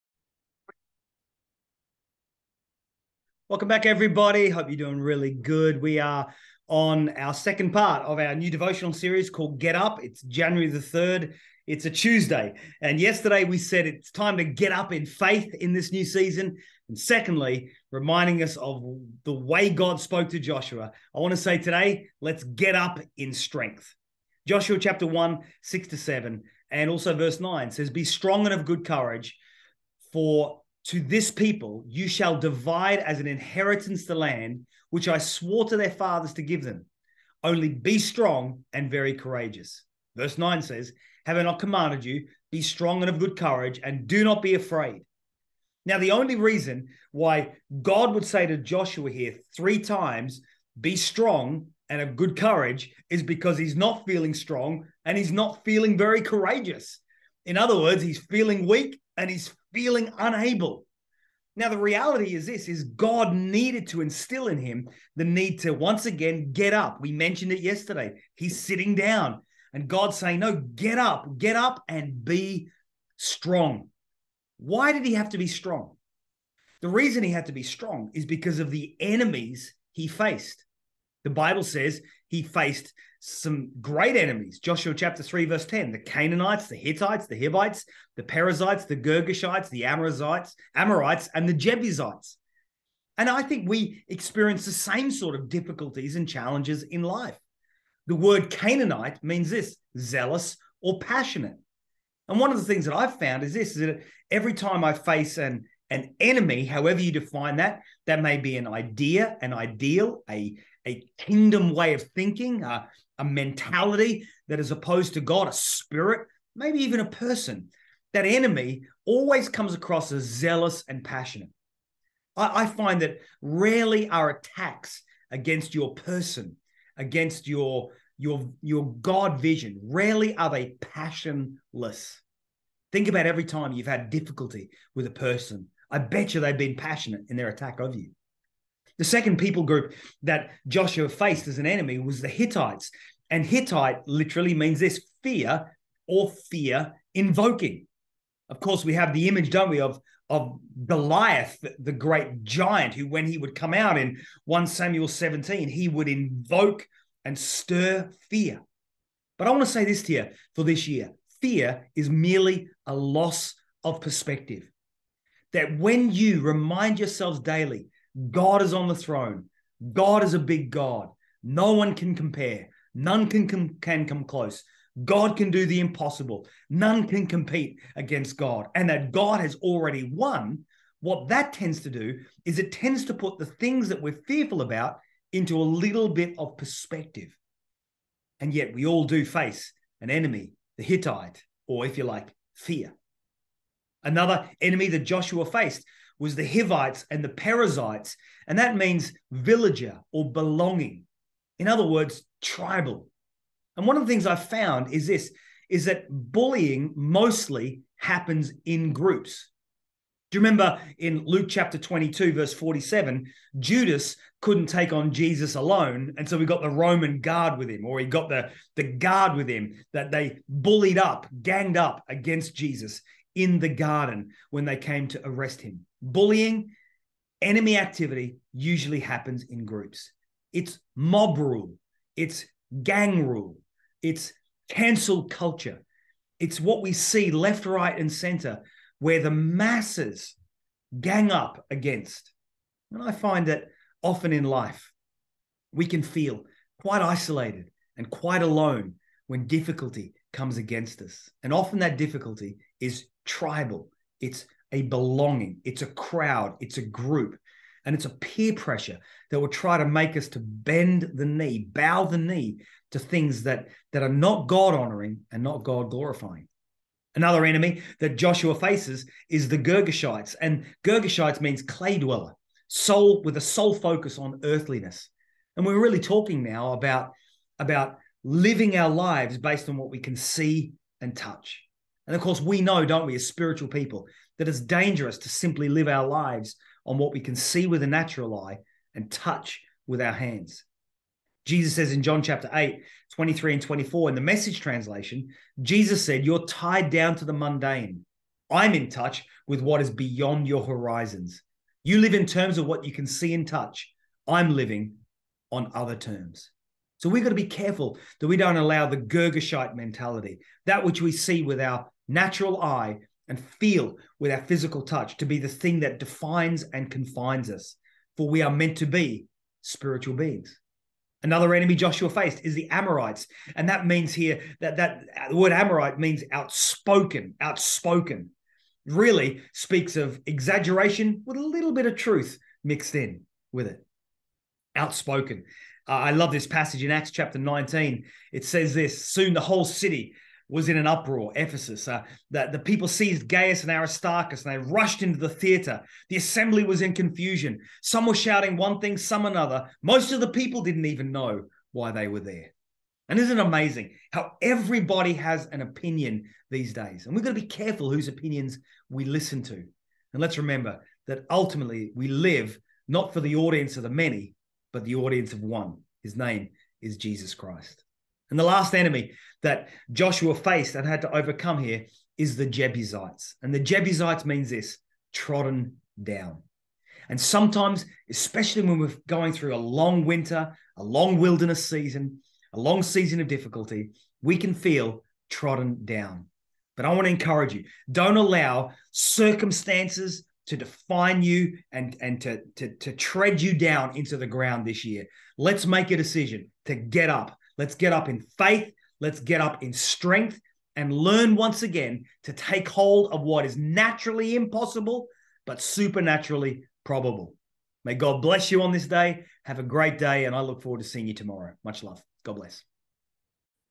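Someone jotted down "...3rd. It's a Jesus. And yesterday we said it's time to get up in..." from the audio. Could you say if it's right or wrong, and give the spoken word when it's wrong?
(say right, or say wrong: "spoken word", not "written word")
wrong: "Tuesday", not "Jesus".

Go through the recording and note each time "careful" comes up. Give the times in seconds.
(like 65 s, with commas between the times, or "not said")
307 s, 357 s.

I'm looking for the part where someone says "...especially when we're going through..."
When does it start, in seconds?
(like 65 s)
378 s.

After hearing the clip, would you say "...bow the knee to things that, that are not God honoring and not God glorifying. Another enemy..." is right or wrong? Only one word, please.
right.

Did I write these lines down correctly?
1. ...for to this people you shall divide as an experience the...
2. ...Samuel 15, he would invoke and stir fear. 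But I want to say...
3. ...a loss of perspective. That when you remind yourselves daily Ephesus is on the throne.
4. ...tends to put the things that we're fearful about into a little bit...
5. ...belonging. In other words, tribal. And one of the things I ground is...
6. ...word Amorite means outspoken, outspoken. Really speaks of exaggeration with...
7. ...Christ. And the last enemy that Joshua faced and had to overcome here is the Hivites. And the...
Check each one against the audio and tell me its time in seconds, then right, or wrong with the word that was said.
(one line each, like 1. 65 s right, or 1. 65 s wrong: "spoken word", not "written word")
1. 30 s wrong: "inheritance", not "experience"
2. 154 s wrong: "17", not "15"
3. 162 s wrong: "God", not "Ephesus"
4. 182 s right
5. 200 s wrong: "found", not "ground"
6. 325 s right
7. 367 s wrong: "Jebusites", not "Hivites".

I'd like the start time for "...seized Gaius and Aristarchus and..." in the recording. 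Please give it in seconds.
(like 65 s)
342 s.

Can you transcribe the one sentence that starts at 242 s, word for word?
And I find that often in life, we can feel quite isolated and quite alone when difficulty comes against us.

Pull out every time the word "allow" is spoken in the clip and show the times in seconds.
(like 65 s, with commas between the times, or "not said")
308 s, 388 s.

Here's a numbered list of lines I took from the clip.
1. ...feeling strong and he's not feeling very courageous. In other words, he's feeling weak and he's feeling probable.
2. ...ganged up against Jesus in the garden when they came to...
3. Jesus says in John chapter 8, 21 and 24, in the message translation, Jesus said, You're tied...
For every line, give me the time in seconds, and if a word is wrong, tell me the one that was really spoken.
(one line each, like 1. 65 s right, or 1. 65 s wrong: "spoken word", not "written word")
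1. 54 s wrong: "unable", not "probable"
2. 221 s right
3. 291 s wrong: "23", not "21".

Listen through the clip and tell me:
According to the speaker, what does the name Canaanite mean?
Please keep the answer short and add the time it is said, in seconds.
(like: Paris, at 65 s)
zealous or passionate, at 99 s.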